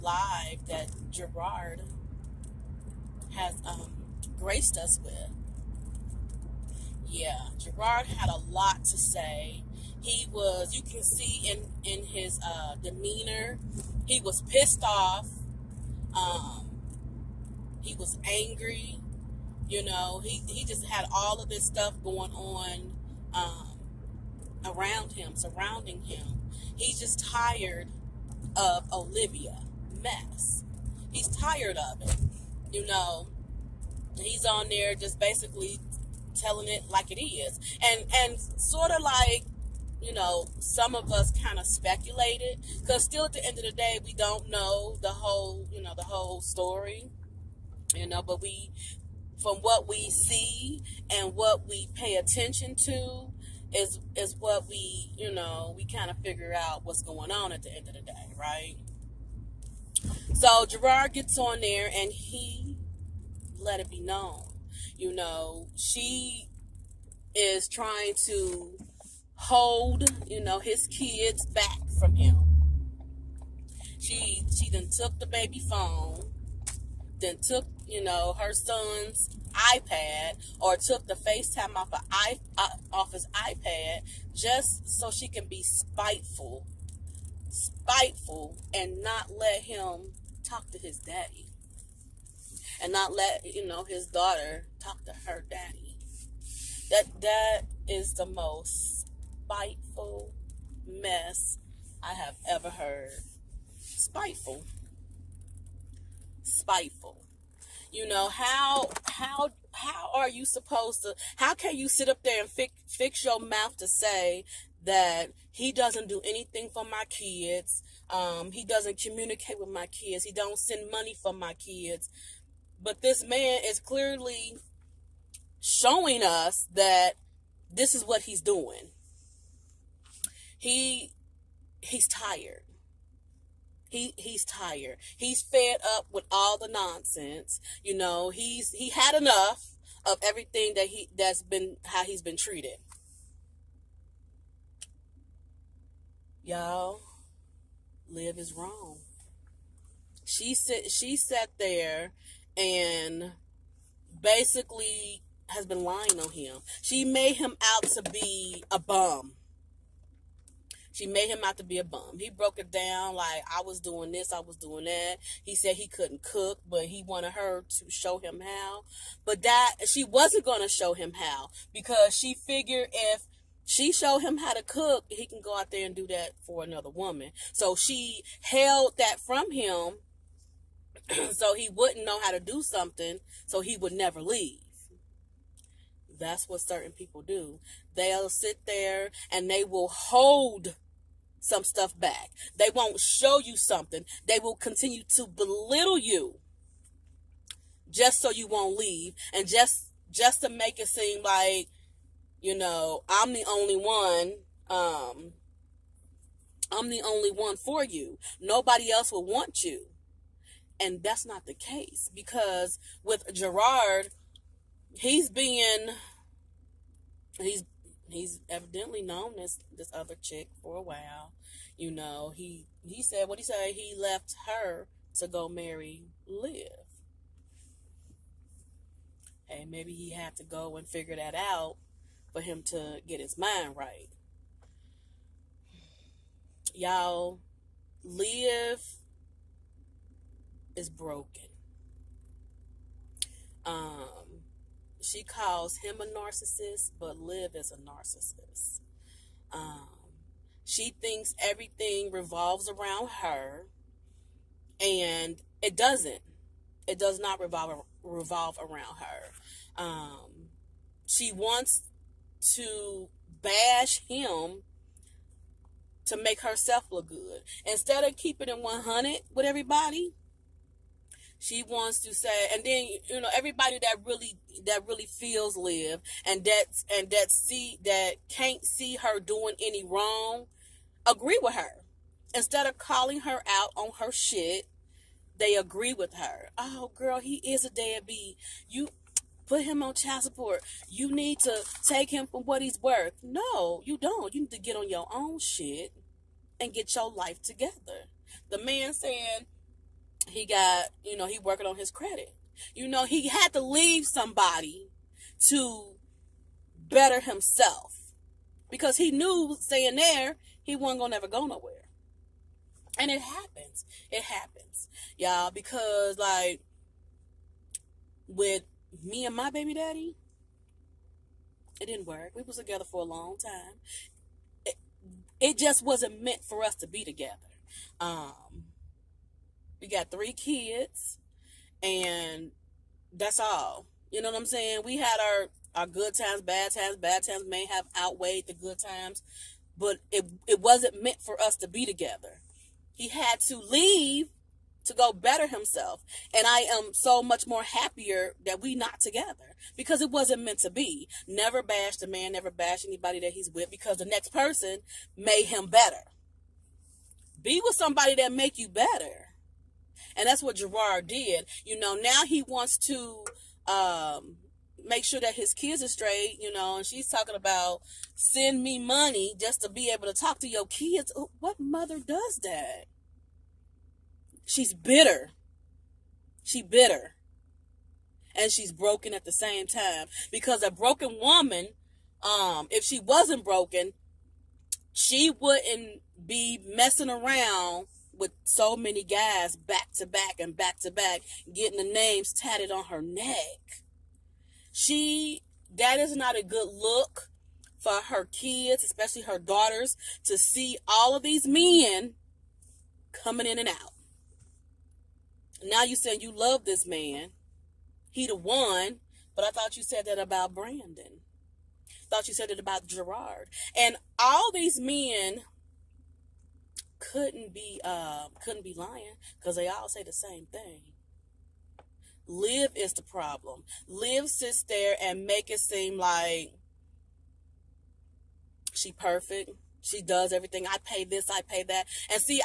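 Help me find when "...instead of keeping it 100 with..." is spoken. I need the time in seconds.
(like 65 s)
267 s.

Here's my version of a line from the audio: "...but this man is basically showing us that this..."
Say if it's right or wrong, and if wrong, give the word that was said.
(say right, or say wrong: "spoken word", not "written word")
wrong: "clearly", not "basically".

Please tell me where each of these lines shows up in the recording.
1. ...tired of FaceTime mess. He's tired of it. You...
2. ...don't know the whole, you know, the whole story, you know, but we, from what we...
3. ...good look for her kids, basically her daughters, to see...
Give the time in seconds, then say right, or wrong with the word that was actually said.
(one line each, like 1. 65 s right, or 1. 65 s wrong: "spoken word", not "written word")
1. 27 s wrong: "Olivia", not "FaceTime"
2. 44 s right
3. 396 s wrong: "especially", not "basically".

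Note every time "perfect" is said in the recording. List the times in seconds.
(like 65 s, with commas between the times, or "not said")
428 s.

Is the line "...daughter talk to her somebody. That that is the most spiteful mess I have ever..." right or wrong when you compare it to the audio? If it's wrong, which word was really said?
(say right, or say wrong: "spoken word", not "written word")
wrong: "daddy", not "somebody".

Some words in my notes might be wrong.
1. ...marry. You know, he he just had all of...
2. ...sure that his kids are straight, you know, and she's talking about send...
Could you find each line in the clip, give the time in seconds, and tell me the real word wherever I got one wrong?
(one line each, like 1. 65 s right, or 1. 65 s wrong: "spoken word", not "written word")
1. 18 s wrong: "angry", not "marry"
2. 365 s right.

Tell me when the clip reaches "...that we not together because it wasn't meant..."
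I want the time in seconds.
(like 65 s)
348 s.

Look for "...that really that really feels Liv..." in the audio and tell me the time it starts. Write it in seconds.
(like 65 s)
273 s.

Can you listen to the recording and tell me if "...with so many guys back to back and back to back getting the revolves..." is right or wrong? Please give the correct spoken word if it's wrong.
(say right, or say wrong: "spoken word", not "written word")
wrong: "names", not "revolves".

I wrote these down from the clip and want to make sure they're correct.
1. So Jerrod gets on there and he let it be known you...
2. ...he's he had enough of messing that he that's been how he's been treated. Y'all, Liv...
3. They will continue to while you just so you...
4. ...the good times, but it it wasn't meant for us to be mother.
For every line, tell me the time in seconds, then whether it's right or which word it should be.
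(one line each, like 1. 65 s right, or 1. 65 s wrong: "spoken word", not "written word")
1. 60 s right
2. 138 s wrong: "everything", not "messing"
3. 194 s wrong: "belittle", not "while"
4. 338 s wrong: "together", not "mother".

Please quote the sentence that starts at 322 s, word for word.
We was together for a long time.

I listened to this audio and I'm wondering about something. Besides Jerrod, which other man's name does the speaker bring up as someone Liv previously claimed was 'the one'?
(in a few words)
Brandon.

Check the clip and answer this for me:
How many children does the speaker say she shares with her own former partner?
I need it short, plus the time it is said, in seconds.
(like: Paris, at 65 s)
3, at 330 s.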